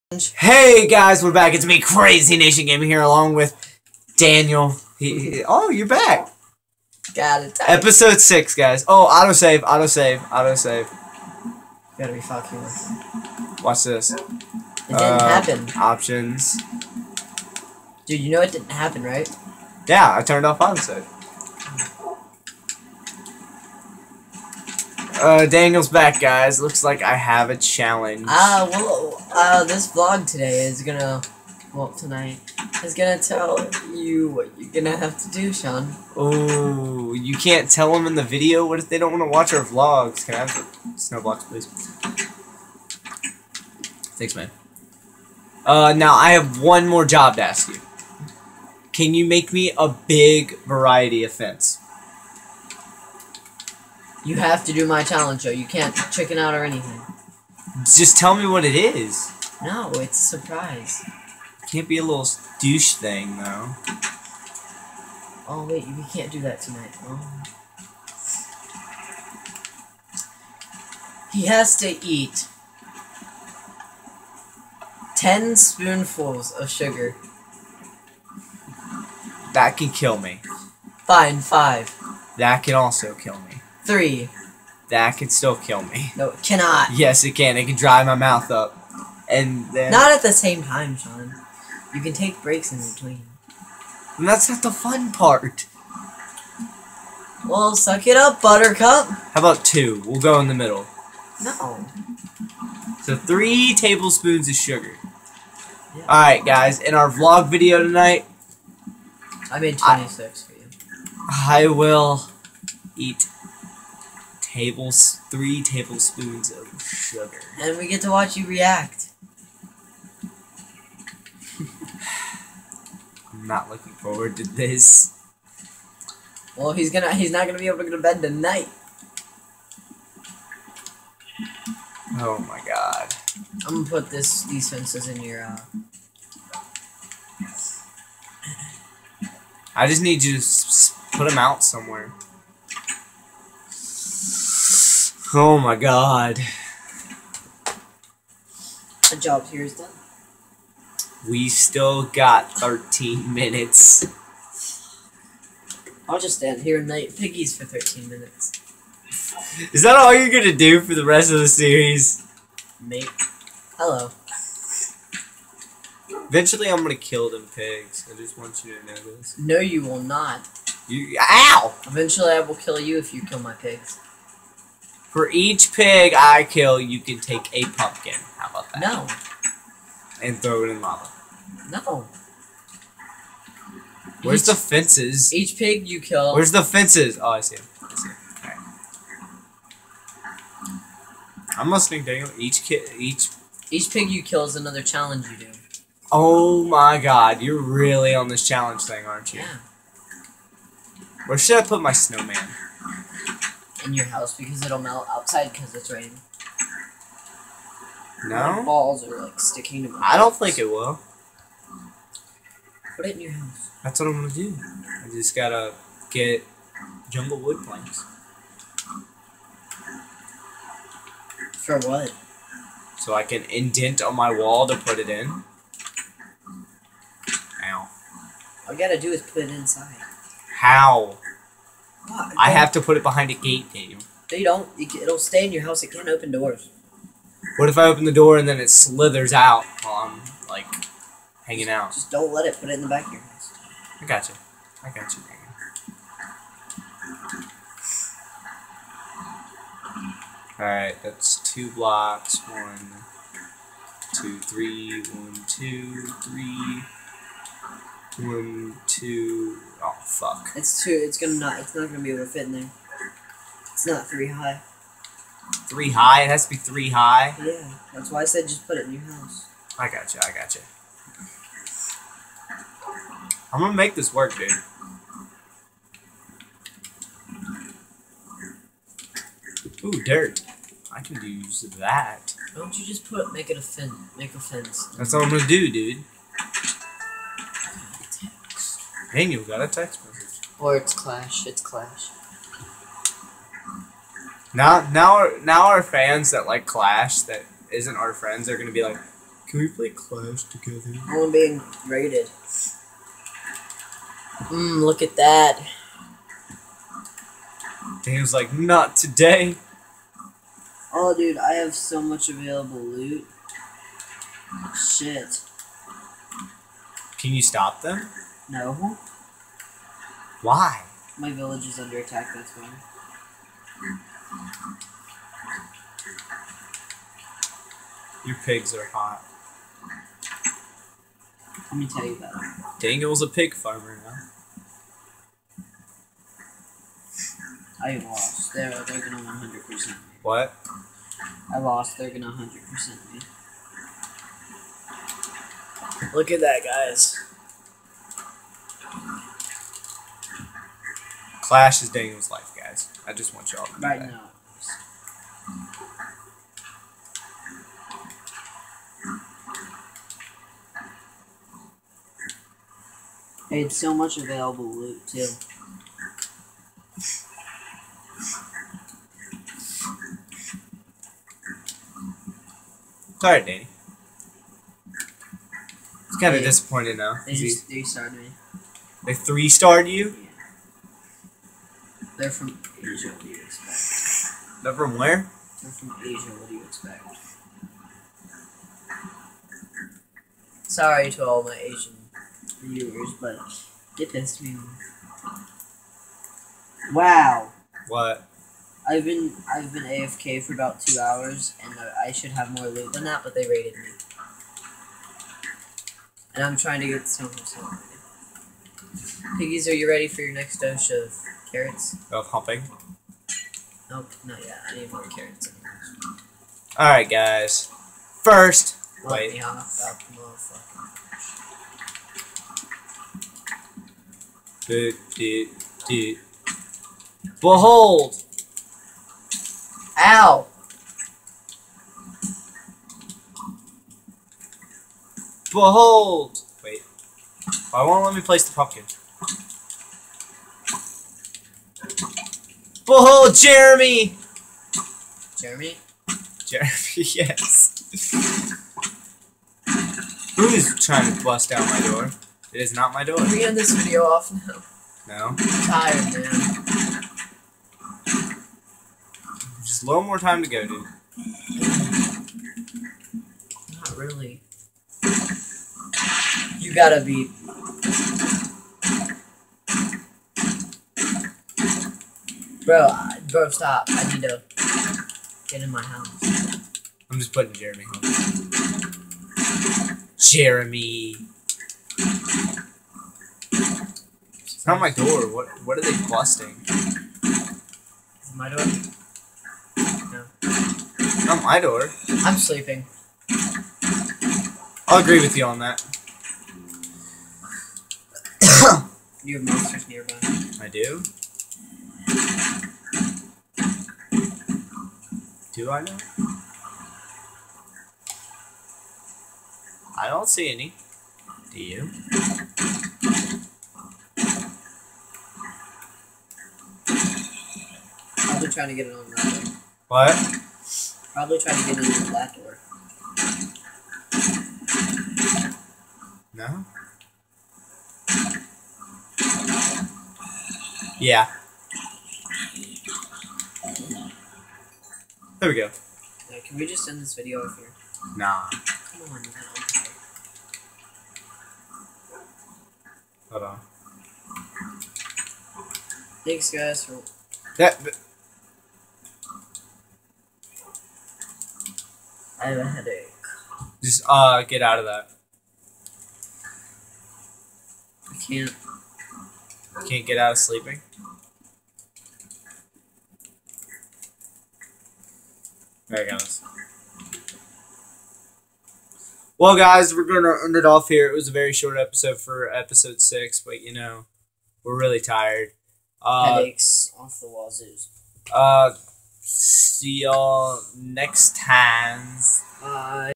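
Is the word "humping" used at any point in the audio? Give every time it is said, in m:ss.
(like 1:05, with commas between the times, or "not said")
6:52.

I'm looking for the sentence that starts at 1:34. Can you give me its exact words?
And that's not the fun part.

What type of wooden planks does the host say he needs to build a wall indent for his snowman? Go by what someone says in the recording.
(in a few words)
Jungle wood planks.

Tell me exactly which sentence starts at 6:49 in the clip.
Piggies, are you ready for your next dose of carrots?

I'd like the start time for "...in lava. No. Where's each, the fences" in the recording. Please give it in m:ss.
3:00.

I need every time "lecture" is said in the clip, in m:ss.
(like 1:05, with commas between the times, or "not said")
not said.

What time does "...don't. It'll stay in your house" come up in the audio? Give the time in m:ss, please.
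3:54.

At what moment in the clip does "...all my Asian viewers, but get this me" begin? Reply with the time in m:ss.
6:31.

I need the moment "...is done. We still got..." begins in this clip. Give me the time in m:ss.
2:29.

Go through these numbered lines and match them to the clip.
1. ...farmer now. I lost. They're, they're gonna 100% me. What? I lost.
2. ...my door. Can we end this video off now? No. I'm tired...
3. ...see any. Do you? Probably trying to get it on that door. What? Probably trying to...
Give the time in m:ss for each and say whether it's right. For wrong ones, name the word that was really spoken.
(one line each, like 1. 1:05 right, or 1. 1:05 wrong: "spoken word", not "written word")
1. 5:33 right
2. 7:32 right
3. 8:30 right.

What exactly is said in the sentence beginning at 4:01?
Just don't let it put it in the back of your house.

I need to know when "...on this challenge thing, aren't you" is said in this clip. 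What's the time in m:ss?
3:18.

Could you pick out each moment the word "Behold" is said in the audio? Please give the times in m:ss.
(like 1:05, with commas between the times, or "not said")
7:07, 7:15, 7:22.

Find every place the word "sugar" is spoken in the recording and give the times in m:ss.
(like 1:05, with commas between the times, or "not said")
1:16, 1:44, 1:56.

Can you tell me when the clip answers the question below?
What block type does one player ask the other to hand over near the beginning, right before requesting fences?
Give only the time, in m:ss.
0:40.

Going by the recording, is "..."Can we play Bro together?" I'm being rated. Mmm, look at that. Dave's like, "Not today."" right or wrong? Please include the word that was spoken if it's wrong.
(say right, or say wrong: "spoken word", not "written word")
wrong: "Clash", not "Bro".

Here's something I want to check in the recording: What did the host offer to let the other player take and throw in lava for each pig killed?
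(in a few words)
A pumpkin.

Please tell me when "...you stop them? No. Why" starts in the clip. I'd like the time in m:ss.
5:17.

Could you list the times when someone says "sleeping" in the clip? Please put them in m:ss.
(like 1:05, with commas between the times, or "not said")
8:12, 9:20.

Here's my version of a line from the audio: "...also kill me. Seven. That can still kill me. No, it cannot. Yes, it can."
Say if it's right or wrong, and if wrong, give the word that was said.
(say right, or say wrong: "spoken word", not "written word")
wrong: "Three", not "Seven".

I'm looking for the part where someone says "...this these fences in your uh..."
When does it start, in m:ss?
2:14.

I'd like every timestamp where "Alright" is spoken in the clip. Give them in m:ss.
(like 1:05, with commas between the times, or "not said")
1:46, 4:10, 6:56, 9:25.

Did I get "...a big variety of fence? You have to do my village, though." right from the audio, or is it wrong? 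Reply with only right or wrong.
wrong.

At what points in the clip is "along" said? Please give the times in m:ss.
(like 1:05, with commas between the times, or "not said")
0:02.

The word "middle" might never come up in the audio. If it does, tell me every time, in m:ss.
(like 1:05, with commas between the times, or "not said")
1:40.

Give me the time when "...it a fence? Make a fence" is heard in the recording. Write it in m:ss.
4:43.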